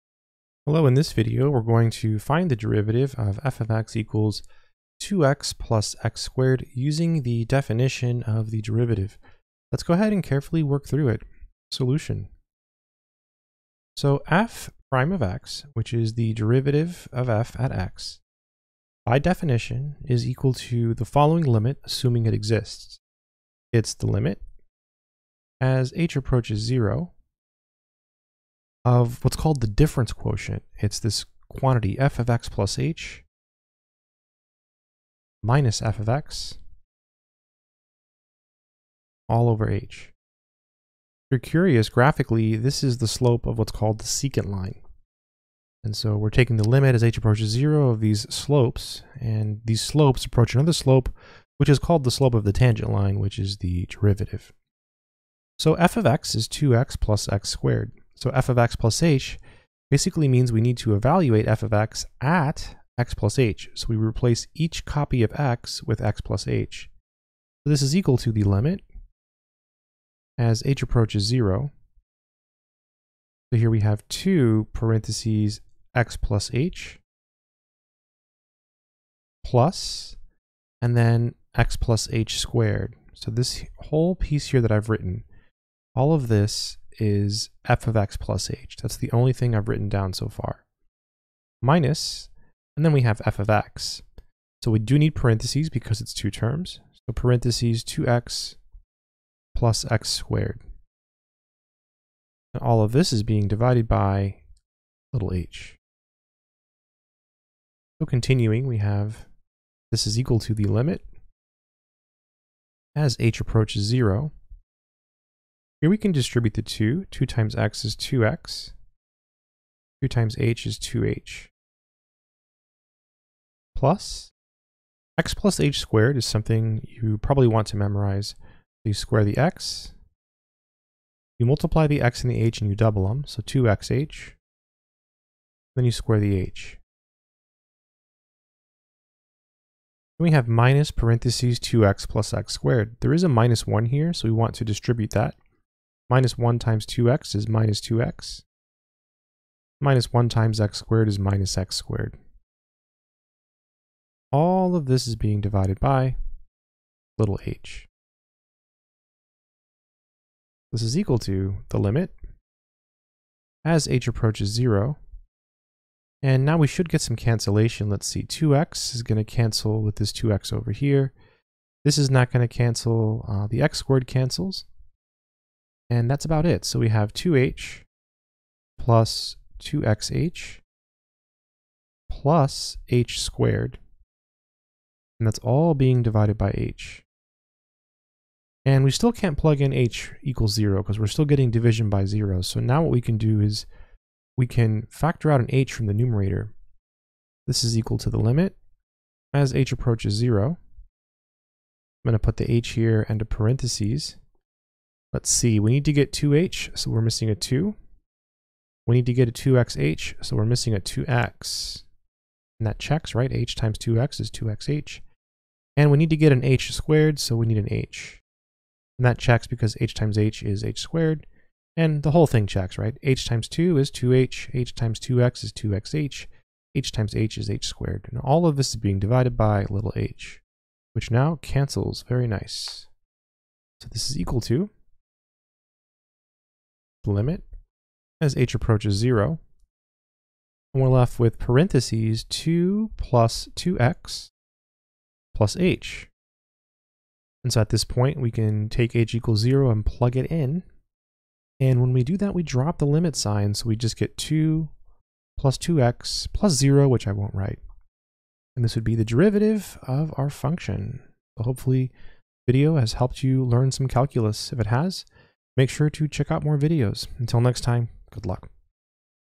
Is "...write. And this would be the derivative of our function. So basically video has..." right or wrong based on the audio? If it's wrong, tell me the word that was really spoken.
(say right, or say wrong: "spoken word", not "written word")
wrong: "hopefully", not "basically".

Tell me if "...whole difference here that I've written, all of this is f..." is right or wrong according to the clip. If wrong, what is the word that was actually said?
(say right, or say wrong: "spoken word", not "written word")
wrong: "piece", not "difference".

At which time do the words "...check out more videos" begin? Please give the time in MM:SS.
04:26.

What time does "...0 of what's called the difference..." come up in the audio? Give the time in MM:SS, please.
00:26.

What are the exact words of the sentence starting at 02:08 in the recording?
So you square the x, you multiply the x and the h and you double them, so 2xh.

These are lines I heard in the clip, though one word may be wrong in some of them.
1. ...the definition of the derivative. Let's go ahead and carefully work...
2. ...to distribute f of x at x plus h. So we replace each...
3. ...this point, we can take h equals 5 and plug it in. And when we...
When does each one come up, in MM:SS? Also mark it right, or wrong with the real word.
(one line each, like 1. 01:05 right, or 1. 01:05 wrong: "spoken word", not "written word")
1. 00:07 right
2. 01:00 wrong: "evaluate", not "distribute"
3. 04:07 wrong: "0", not "5".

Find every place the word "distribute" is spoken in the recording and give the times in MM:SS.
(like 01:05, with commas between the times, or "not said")
01:56, 02:24.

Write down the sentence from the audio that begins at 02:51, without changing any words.
This is not going to cancel.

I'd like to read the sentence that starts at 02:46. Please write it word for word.
And now we should get some cancellation.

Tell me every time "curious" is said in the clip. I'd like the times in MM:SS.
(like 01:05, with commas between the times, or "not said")
00:41.